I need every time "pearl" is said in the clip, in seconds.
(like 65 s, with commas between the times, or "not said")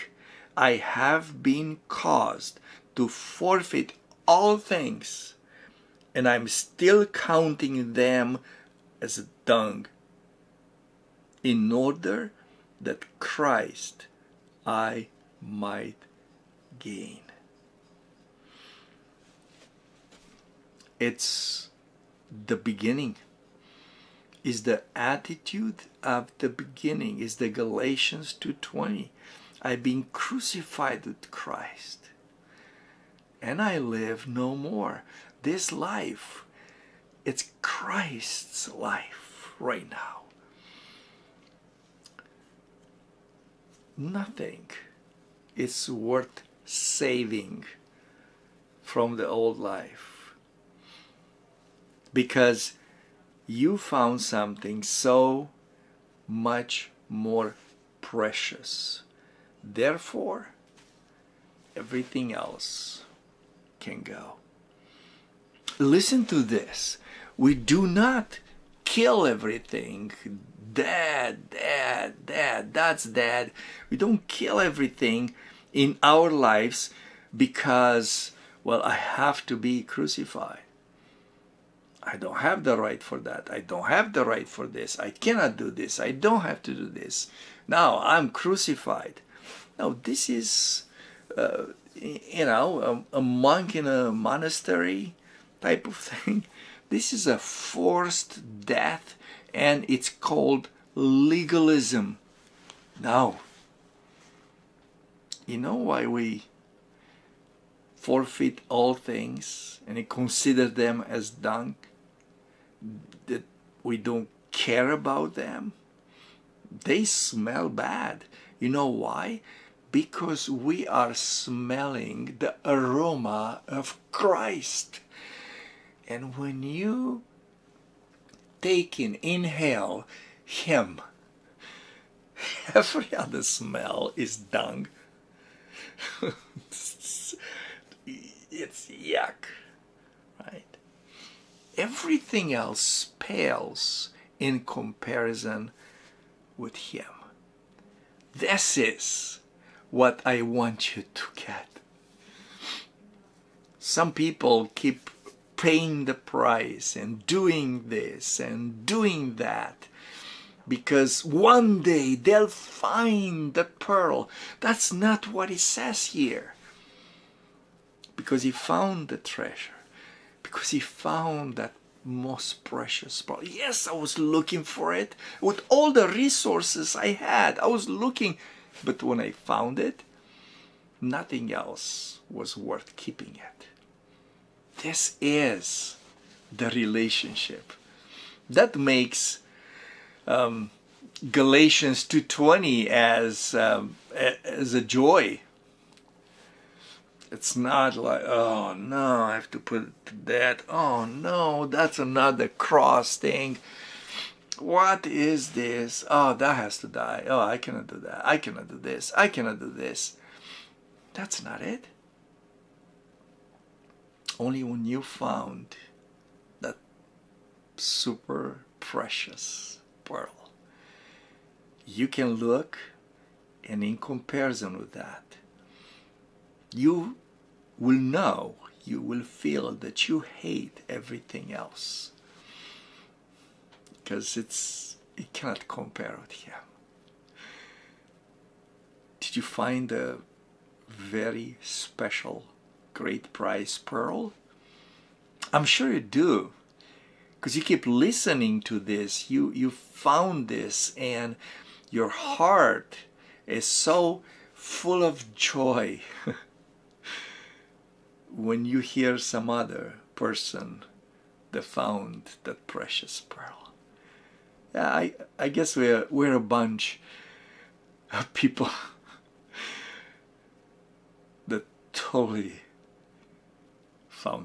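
163 s, 173 s, 220 s, 243 s, 263 s.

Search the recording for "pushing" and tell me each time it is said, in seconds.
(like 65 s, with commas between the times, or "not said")
not said.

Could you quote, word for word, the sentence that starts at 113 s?
we don't care about them, they smell bad.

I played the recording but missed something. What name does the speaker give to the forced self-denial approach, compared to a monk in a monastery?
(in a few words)
Legalism.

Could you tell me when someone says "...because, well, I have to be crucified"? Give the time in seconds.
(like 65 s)
77 s.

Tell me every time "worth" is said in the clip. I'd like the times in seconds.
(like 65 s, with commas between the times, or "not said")
45 s, 182 s.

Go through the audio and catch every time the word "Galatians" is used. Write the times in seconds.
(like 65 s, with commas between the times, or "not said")
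27 s, 191 s.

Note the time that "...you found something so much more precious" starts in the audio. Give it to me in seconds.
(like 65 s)
53 s.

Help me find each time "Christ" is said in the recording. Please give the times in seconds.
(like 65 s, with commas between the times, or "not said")
13 s, 31 s, 37 s, 124 s.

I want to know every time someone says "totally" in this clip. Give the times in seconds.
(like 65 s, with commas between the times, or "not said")
271 s.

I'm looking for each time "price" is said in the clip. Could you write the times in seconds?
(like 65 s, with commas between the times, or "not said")
156 s.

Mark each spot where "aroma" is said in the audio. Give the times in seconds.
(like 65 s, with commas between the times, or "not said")
122 s.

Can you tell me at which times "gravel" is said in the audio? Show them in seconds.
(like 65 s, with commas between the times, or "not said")
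not said.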